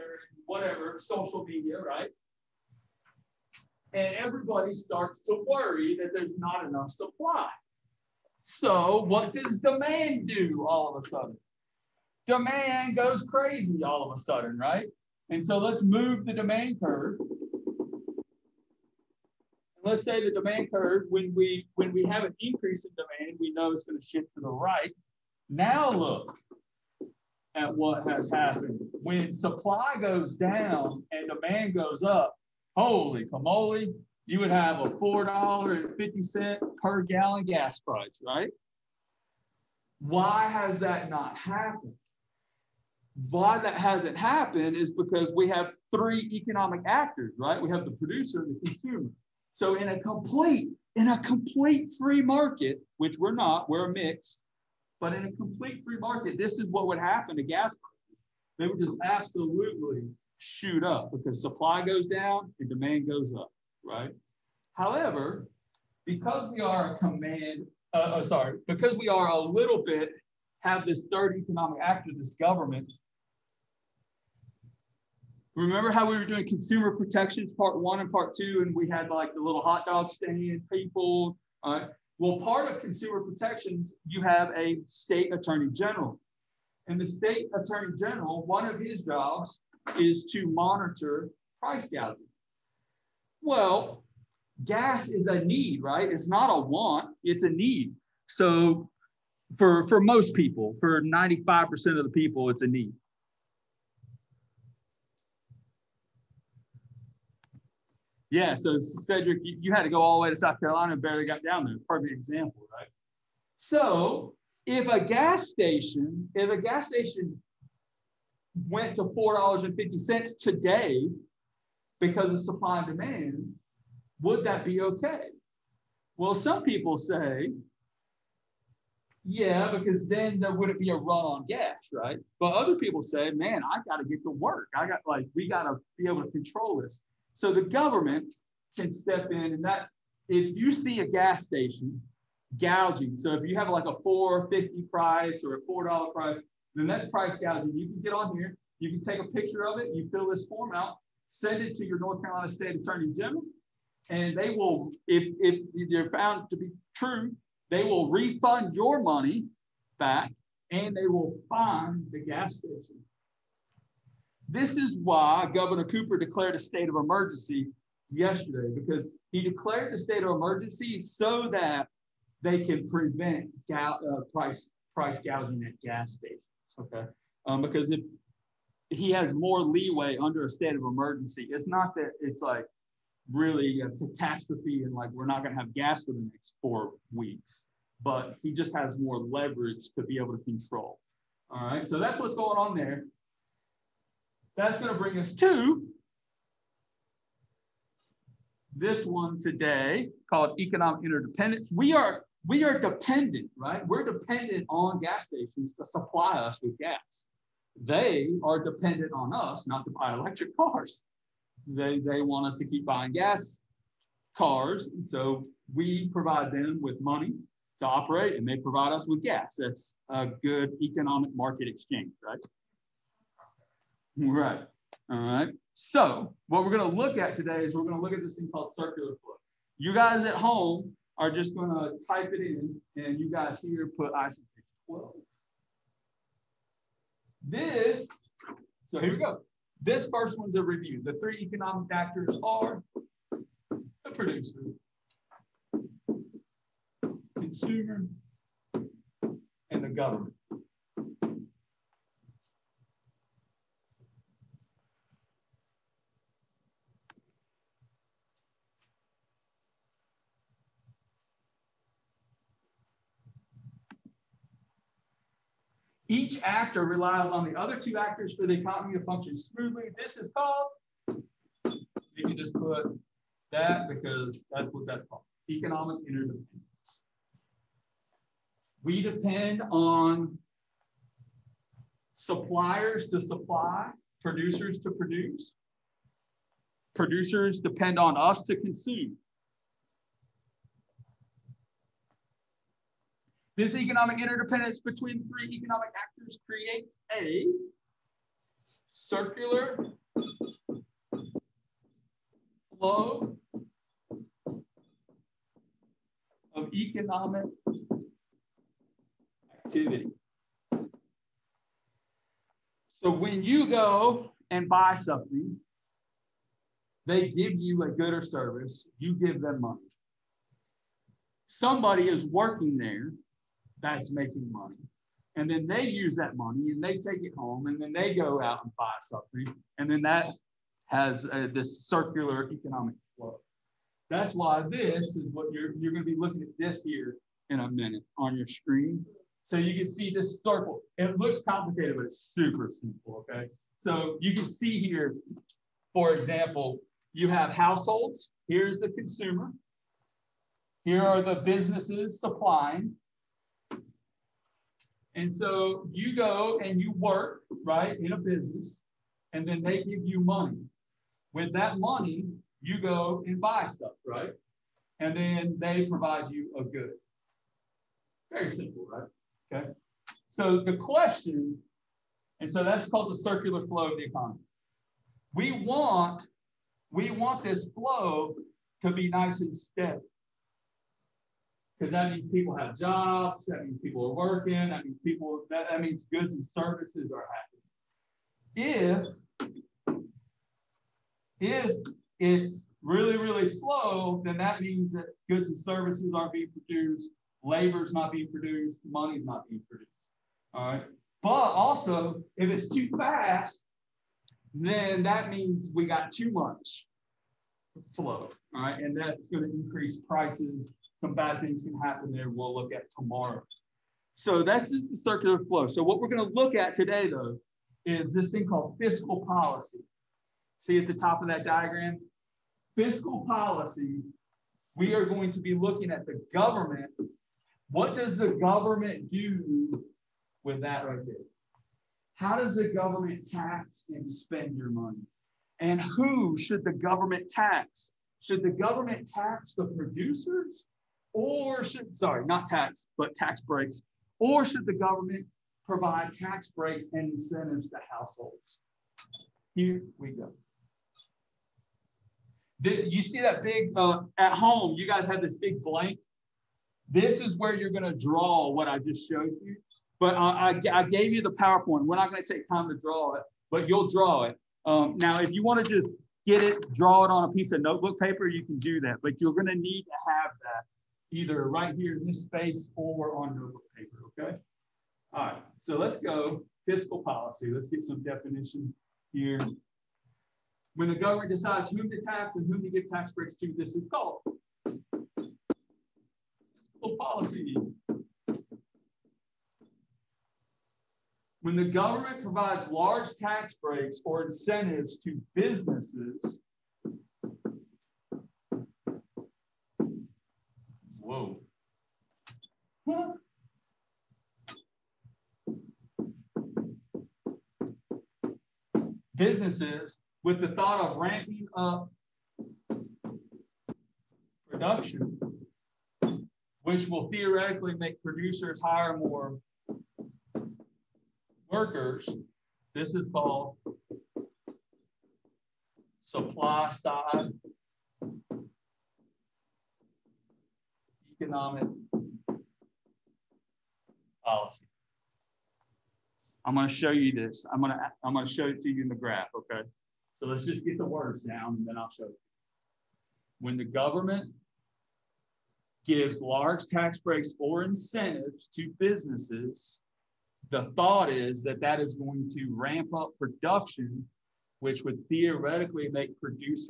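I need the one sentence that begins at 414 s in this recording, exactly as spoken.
So that's just the circular flow.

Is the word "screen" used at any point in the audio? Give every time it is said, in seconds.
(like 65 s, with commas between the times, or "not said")
338 s.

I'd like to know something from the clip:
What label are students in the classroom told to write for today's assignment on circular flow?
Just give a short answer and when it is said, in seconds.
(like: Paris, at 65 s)
ICP 12, at 234 s.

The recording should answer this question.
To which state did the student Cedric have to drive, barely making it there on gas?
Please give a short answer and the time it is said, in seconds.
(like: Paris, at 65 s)
South Carolina, at 110 s.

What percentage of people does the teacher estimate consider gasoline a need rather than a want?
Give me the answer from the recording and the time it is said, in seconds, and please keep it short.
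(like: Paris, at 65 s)
95%, at 101 s.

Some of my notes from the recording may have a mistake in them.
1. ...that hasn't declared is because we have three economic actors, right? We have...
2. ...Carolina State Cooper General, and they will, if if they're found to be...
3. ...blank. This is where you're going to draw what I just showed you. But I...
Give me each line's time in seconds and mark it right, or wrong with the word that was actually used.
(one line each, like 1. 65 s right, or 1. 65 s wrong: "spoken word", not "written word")
1. 43 s wrong: "happened", not "declared"
2. 152 s wrong: "Attorney", not "Cooper"
3. 455 s right.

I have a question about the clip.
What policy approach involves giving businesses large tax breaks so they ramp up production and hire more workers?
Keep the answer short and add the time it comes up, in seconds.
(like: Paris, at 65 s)
supply side economic policy, at 526 s.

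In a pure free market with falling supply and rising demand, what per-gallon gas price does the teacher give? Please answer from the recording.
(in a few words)
$4.50.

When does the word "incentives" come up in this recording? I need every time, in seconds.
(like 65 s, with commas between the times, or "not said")
447 s, 494 s, 547 s.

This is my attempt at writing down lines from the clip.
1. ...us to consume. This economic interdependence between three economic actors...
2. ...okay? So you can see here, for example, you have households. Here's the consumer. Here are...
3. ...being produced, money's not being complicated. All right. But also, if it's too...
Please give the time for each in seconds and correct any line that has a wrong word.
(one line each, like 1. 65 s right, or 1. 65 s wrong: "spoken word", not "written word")
1. 288 s right
2. 343 s right
3. 398 s wrong: "produced", not "complicated".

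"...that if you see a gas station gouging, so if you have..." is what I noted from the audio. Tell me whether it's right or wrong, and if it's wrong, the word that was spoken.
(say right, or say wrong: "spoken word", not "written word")
right.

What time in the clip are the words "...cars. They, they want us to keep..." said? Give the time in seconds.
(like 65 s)
210 s.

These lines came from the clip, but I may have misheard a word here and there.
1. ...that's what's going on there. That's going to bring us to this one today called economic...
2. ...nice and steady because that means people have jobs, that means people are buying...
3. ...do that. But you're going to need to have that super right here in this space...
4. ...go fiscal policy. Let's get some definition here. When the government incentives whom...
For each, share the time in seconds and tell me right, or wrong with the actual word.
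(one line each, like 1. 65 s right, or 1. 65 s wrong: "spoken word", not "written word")
1. 191 s right
2. 379 s wrong: "working", not "buying"
3. 468 s wrong: "either", not "super"
4. 475 s wrong: "decides", not "incentives".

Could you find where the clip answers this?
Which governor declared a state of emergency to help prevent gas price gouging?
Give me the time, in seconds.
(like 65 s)
165 s.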